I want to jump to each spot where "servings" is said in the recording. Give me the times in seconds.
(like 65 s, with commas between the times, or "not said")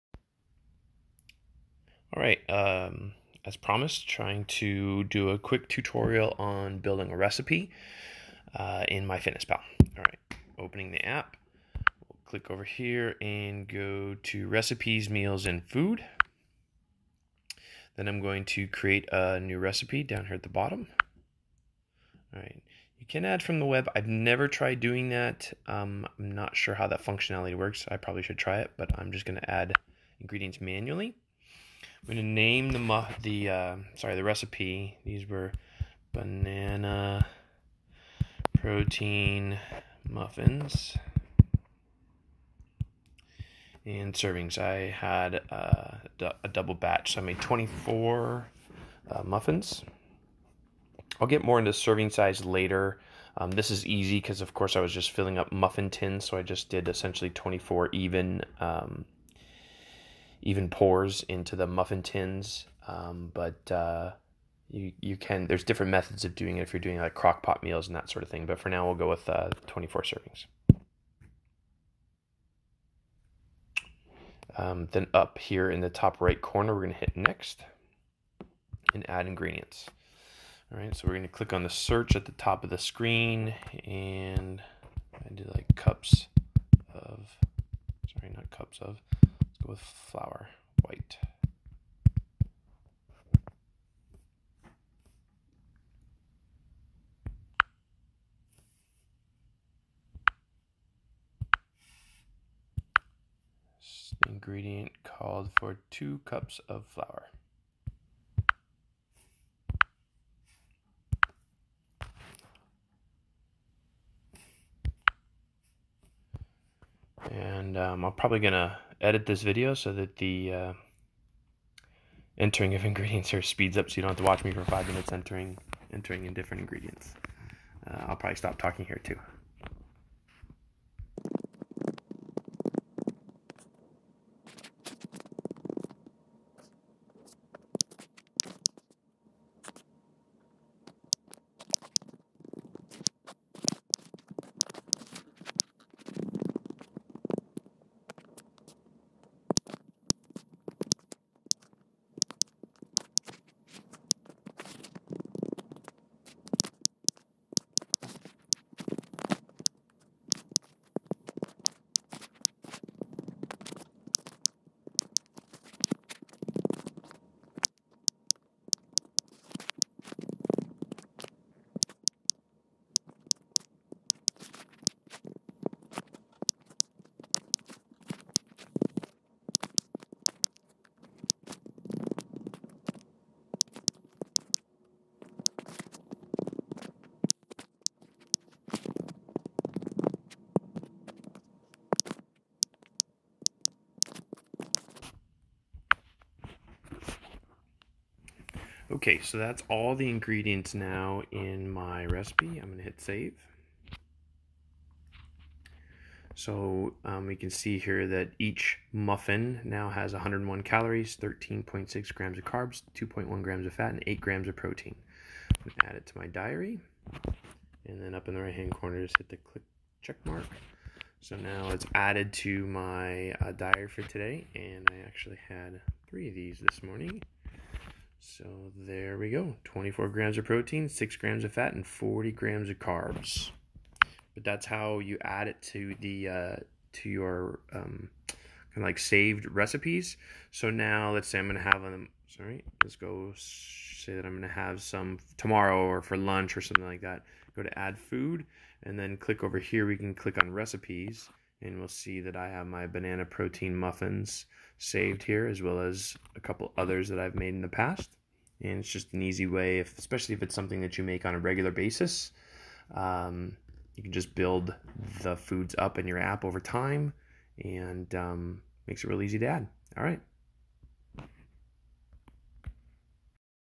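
44 s, 51 s, 70 s.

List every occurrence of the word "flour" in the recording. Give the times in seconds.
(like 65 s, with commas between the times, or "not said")
89 s, 106 s.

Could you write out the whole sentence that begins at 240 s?
So now let's say I'm going to have them.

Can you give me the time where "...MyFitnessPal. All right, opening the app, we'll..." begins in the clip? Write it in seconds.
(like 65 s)
9 s.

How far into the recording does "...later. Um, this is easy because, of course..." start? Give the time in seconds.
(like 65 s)
52 s.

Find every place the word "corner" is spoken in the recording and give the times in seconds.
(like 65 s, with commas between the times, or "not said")
76 s, 218 s.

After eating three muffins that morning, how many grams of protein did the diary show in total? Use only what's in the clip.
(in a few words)
24 grams.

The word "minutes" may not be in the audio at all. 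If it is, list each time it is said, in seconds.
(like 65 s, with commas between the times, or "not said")
124 s.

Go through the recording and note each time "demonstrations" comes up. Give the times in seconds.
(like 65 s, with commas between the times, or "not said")
not said.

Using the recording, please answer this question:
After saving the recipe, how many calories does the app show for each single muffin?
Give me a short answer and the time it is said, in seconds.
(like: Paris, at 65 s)
101, at 210 s.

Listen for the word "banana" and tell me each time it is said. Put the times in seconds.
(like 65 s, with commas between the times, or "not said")
36 s, 252 s.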